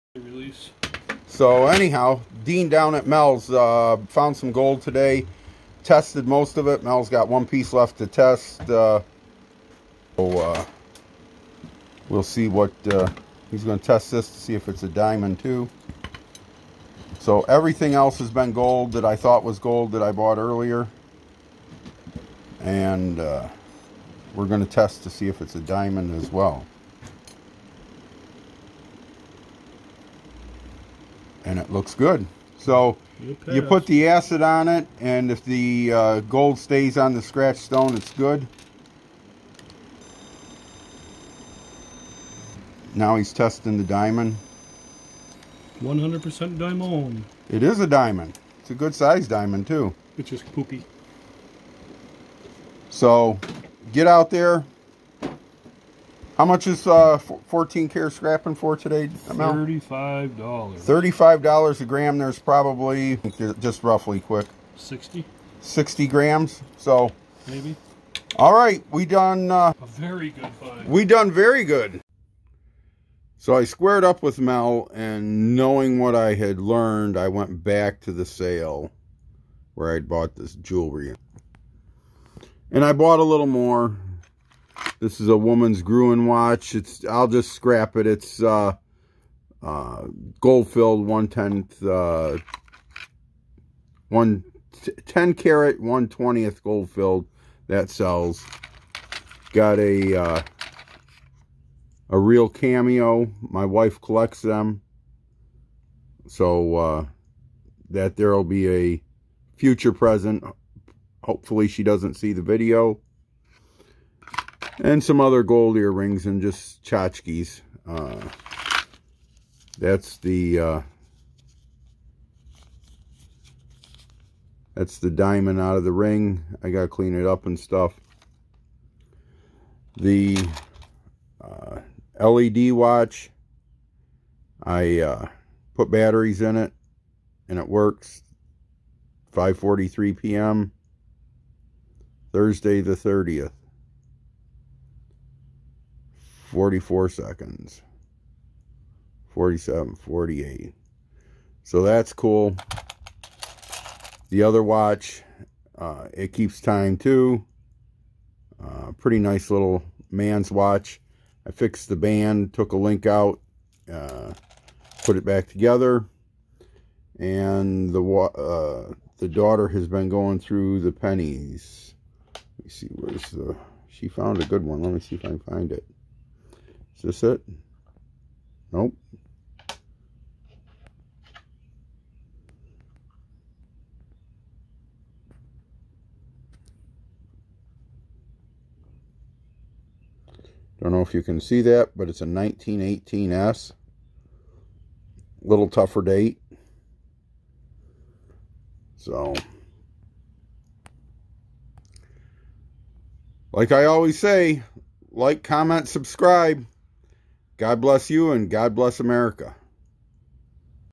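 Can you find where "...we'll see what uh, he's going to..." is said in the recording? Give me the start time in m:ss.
0:12.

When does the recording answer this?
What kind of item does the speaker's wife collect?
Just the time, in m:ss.
1:42.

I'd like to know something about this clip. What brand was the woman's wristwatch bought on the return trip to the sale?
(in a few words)
Gruen.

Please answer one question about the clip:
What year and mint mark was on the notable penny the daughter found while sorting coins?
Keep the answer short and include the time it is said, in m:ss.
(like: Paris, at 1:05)
1918S, at 3:12.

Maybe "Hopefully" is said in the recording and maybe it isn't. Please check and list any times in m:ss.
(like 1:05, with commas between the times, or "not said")
1:51.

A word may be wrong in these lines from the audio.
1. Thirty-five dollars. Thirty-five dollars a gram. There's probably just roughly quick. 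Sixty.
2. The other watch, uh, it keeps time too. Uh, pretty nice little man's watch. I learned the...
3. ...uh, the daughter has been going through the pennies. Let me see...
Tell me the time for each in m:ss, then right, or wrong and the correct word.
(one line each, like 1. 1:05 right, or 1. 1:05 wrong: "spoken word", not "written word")
1. 0:59 right
2. 2:34 wrong: "fixed", not "learned"
3. 2:48 right.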